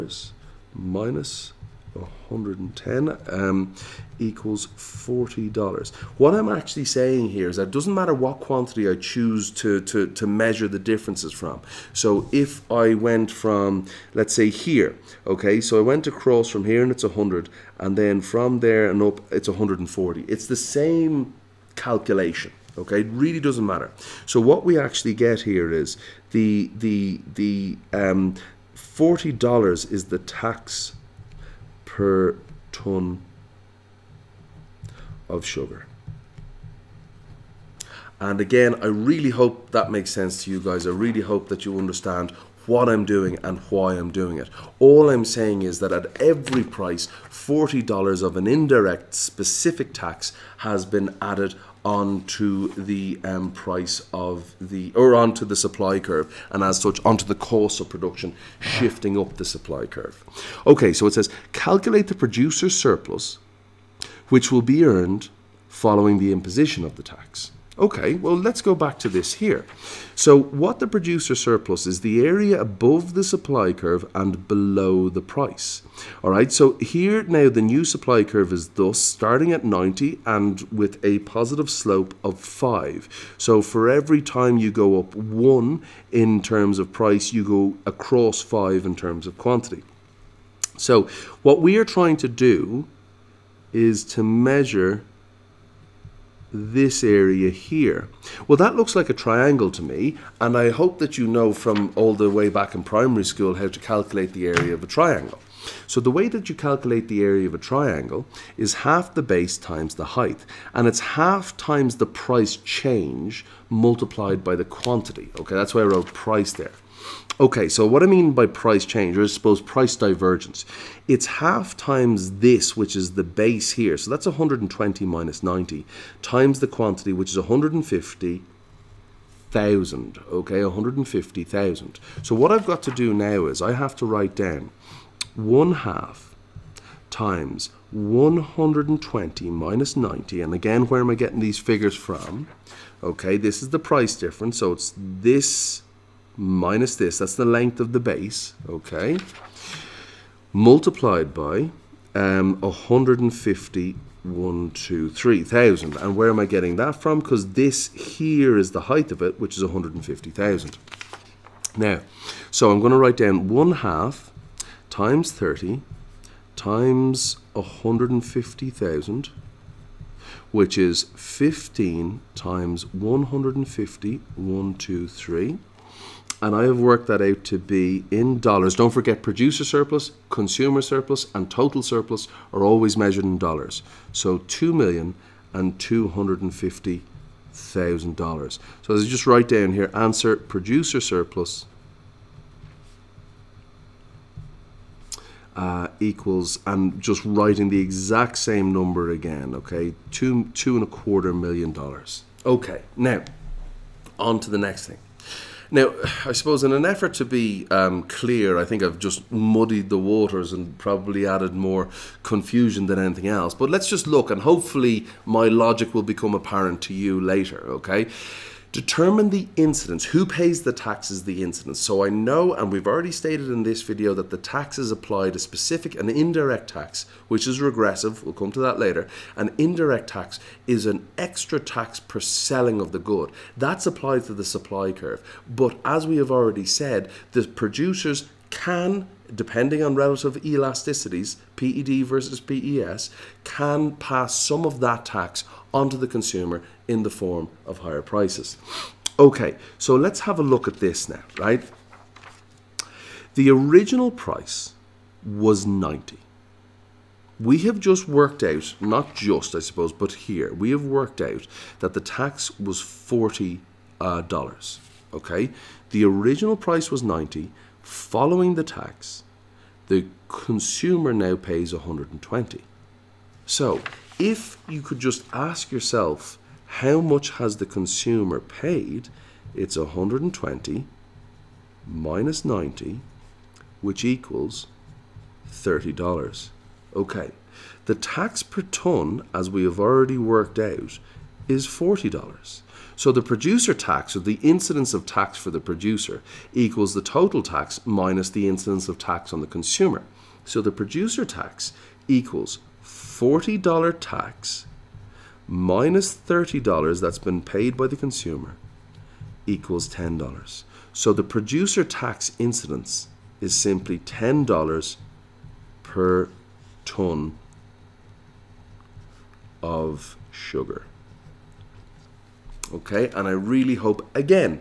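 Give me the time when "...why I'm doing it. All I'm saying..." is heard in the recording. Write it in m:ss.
0:43.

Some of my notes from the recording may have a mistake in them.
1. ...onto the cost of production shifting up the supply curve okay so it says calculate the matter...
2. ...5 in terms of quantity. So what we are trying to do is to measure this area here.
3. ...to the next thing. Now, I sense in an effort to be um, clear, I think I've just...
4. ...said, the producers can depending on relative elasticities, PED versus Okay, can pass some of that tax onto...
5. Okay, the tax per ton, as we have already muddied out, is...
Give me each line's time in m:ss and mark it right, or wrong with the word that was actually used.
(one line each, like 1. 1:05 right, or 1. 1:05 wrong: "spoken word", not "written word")
1. 0:57 wrong: "producer", not "matter"
2. 1:28 right
3. 3:24 wrong: "suppose", not "sense"
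4. 3:56 wrong: "PES", not "Okay"
5. 4:46 wrong: "worked", not "muddied".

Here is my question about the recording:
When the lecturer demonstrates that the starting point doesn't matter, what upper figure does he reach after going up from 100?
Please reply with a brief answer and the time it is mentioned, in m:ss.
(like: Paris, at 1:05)
140, at 0:19.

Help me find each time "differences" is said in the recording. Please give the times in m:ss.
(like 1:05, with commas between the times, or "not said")
0:10, 2:24.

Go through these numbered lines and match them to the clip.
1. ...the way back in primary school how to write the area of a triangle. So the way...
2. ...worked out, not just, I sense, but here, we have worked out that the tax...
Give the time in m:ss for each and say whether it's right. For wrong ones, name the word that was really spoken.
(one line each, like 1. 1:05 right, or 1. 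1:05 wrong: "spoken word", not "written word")
1. 1:42 wrong: "calculate", not "write"
2. 4:18 wrong: "suppose", not "sense".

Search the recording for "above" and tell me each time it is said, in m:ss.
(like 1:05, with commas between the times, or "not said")
1:12.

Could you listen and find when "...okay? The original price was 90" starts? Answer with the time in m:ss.
4:25.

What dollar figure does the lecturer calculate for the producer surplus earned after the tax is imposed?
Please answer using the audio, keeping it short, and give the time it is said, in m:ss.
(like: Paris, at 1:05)
$2,250,000, at 3:04.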